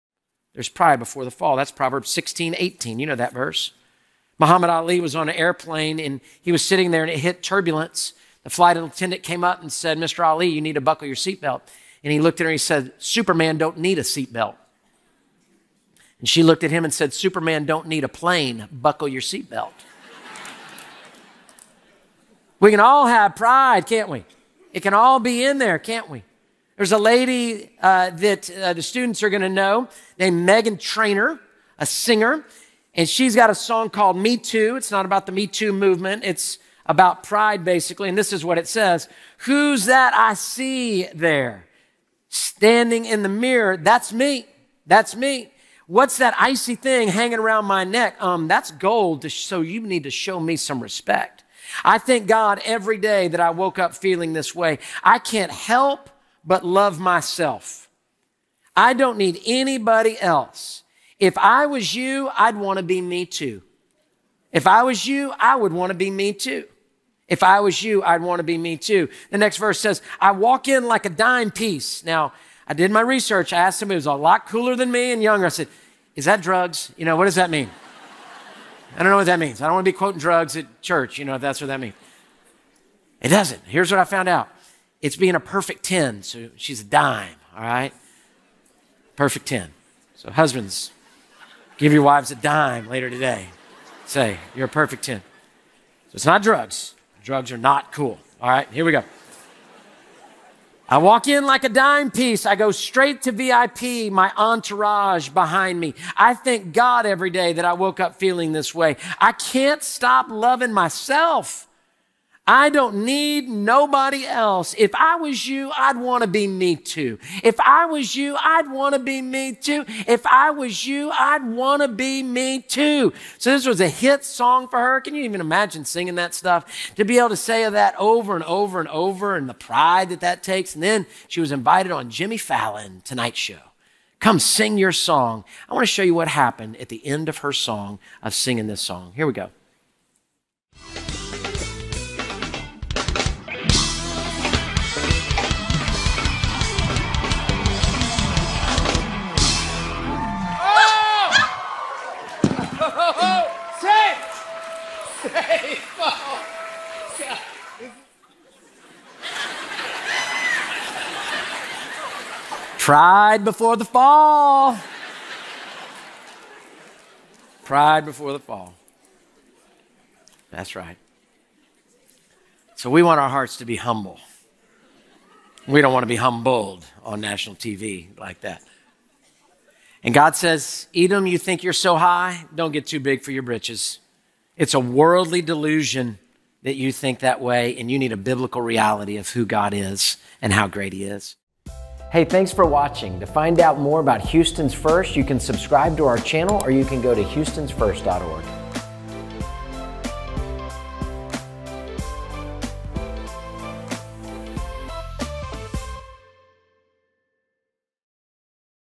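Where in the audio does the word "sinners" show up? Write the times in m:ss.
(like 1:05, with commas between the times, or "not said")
not said.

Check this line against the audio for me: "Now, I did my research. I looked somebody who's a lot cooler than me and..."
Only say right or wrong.
wrong.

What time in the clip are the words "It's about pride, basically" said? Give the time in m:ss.
0:36.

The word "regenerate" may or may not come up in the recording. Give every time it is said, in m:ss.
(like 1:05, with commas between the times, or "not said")
not said.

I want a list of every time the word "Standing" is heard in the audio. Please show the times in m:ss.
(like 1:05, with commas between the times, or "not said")
0:42.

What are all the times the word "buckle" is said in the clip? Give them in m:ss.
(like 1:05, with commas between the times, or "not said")
0:10, 0:18.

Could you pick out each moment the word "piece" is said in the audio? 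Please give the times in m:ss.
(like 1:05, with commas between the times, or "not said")
1:11, 1:42.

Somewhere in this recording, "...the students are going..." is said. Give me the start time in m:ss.
0:28.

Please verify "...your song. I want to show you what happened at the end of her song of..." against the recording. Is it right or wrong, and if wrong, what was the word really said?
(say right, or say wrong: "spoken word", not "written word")
right.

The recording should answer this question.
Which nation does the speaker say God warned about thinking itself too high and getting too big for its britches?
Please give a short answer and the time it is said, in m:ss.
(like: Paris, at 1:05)
Edom, at 3:00.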